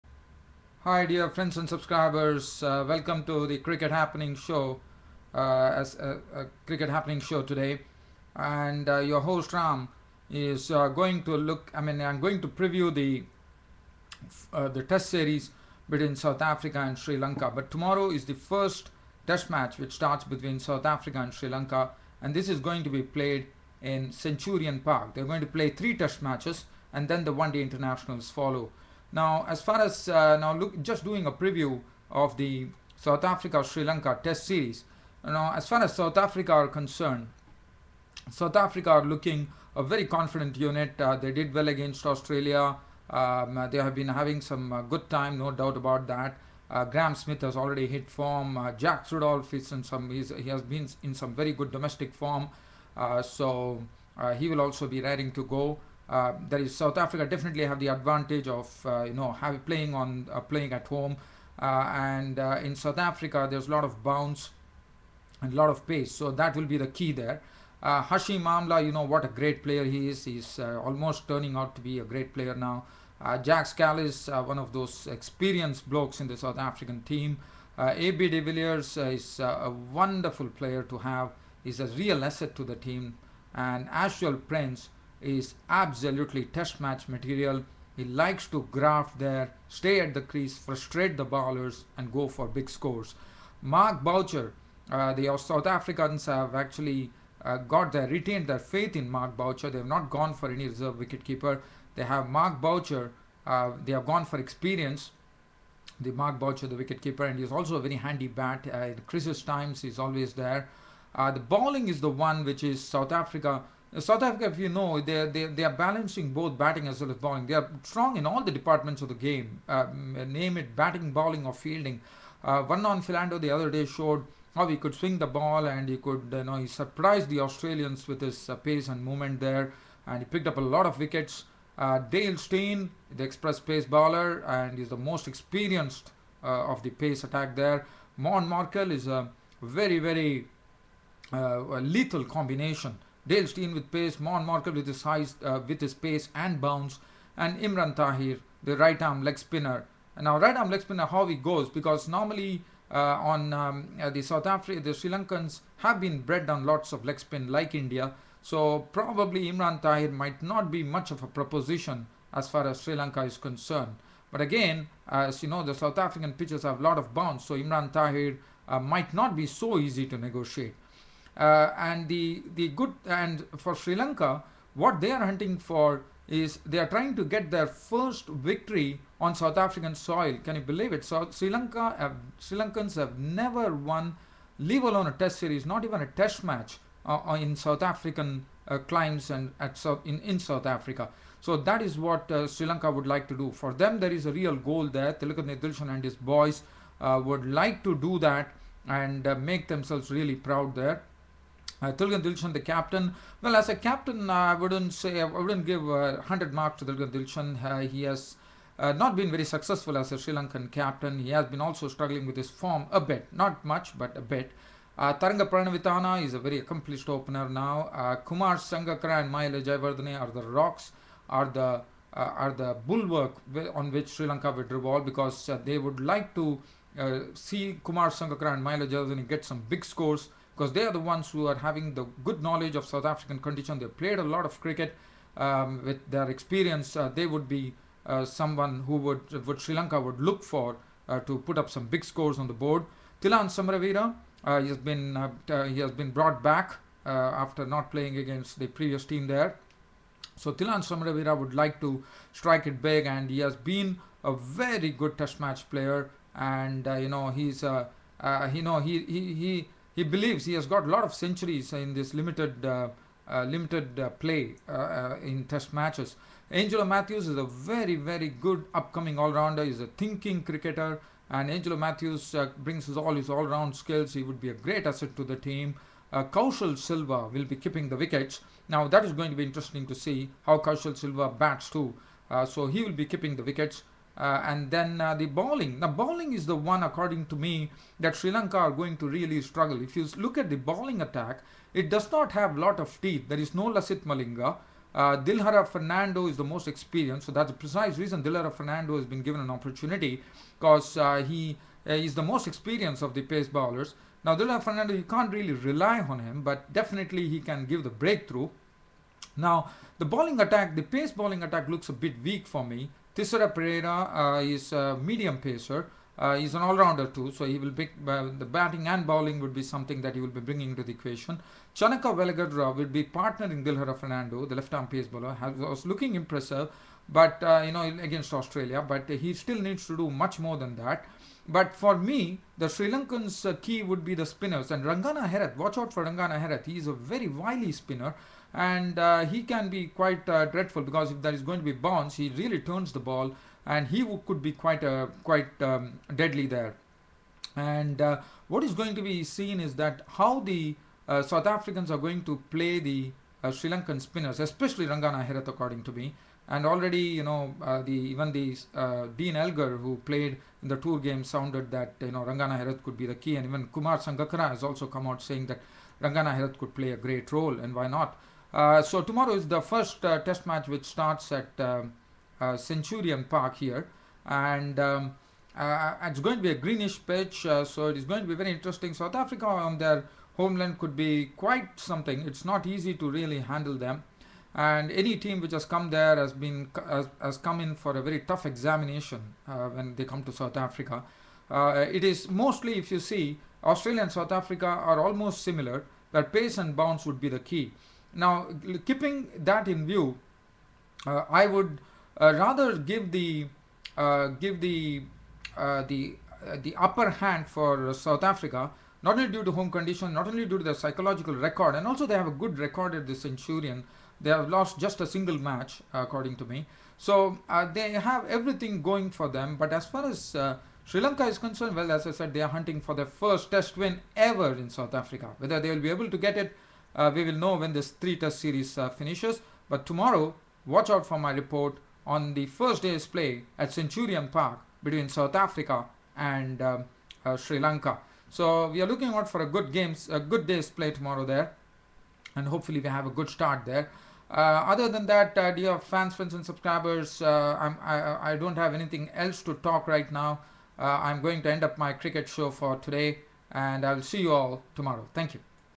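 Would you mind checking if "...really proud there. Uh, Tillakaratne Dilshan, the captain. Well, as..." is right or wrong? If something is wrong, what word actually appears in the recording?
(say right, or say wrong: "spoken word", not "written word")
right.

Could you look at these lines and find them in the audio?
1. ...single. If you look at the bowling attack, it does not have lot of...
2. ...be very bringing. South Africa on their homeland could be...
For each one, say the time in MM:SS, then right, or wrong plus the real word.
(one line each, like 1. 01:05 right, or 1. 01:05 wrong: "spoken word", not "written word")
1. 04:49 wrong: "struggle", not "single"
2. 06:18 wrong: "interesting", not "bringing".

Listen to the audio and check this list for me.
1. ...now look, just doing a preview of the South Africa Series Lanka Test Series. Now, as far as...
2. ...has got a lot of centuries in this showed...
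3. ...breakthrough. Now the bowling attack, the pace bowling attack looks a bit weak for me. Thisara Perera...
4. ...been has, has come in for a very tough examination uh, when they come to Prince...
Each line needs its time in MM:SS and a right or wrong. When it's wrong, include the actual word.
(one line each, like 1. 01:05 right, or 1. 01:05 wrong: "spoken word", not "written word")
1. 00:30 wrong: "Sri", not "Series"
2. 04:20 wrong: "limited", not "showed"
3. 05:07 right
4. 06:26 wrong: "South", not "Prince".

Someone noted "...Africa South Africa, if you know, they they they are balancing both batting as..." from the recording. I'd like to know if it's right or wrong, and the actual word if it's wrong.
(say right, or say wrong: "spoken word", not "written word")
right.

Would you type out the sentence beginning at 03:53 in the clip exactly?
They played a lot of cricket um, with their experience.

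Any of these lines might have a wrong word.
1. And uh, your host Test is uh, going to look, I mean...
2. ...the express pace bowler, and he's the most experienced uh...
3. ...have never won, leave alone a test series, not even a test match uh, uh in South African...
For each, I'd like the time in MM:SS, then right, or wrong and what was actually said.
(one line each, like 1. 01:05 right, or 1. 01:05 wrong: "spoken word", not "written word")
1. 00:08 wrong: "Ram", not "Test"
2. 02:13 right
3. 03:02 right.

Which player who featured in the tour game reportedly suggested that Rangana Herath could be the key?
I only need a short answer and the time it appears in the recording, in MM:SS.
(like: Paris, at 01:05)
Dean Elgar, at 05:59.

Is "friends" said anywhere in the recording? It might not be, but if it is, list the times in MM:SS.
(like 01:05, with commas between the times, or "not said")
00:01, 07:26.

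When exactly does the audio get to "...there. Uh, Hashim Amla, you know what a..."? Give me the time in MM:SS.
01:07.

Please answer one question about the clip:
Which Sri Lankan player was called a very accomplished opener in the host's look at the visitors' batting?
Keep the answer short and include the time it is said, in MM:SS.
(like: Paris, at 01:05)
Tharanga Paranavitana, at 03:35.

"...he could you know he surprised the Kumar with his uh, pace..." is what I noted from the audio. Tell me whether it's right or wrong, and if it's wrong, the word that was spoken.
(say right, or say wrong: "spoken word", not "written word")
wrong: "Australians", not "Kumar".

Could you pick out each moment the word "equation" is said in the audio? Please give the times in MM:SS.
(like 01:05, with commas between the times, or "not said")
05:20.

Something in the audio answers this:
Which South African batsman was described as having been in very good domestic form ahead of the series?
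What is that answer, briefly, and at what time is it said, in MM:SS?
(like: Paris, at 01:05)
Jacques Rudolph, at 00:48.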